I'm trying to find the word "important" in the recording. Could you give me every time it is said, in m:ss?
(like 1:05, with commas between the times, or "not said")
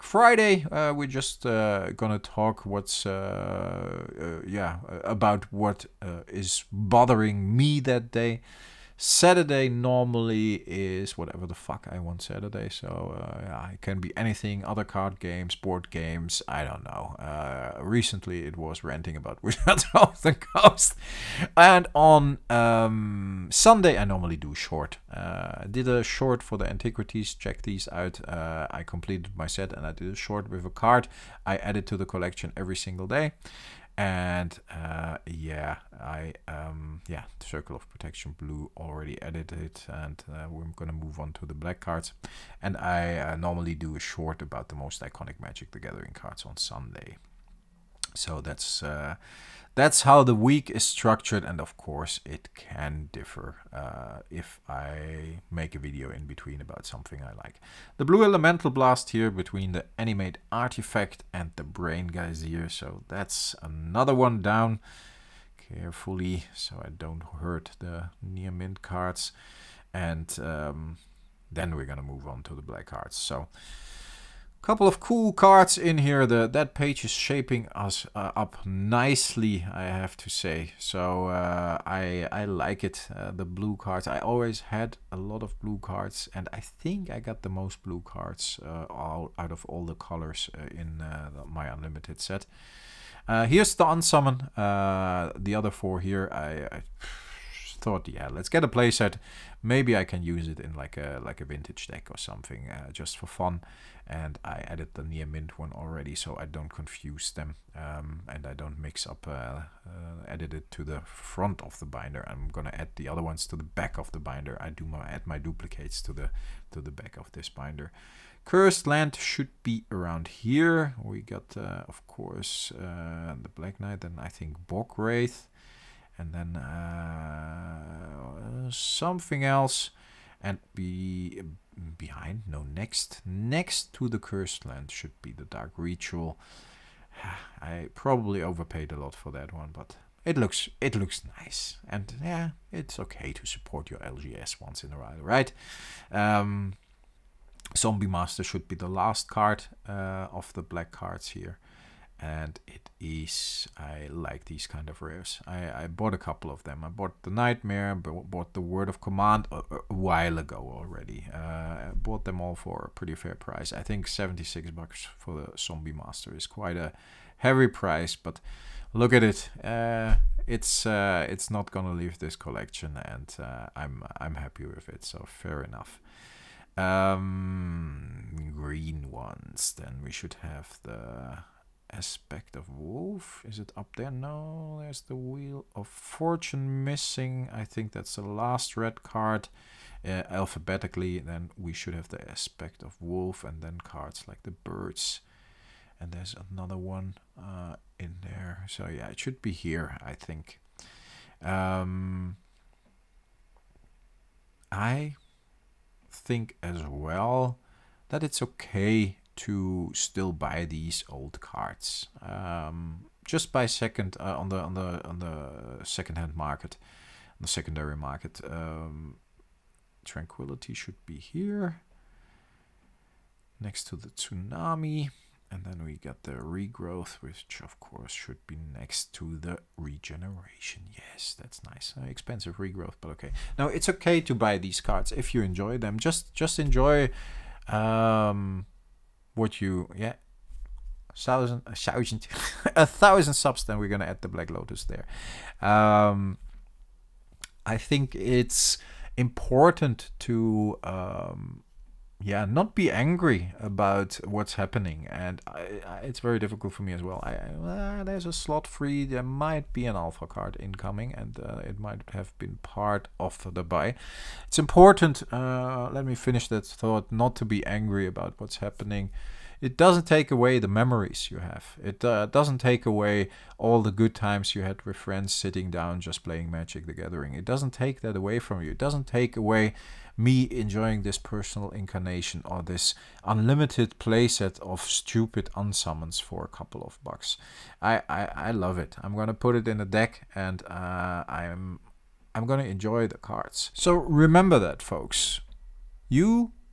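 4:09, 4:24.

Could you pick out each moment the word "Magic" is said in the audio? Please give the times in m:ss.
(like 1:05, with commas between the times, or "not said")
0:45, 4:36.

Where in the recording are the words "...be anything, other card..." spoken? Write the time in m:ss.
0:13.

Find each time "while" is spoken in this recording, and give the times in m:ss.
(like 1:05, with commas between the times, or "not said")
2:24, 2:39.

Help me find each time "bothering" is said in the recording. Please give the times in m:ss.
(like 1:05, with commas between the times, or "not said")
0:06.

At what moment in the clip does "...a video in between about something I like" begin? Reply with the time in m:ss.
0:55.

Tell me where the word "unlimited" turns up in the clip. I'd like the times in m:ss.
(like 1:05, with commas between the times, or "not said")
1:31, 4:43.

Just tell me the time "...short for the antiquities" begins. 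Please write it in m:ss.
0:26.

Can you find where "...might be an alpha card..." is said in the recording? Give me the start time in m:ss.
4:19.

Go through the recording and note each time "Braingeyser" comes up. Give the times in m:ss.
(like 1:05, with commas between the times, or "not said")
1:01.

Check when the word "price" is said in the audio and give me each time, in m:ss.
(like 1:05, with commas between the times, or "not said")
2:43, 2:47.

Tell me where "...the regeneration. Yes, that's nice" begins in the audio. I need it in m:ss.
3:49.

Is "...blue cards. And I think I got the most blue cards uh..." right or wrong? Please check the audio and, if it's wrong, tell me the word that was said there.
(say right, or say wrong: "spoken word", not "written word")
right.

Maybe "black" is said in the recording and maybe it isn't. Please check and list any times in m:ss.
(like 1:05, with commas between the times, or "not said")
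0:41, 1:12, 2:03, 2:30, 4:04.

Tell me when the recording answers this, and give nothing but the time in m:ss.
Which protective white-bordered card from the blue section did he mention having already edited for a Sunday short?
0:37.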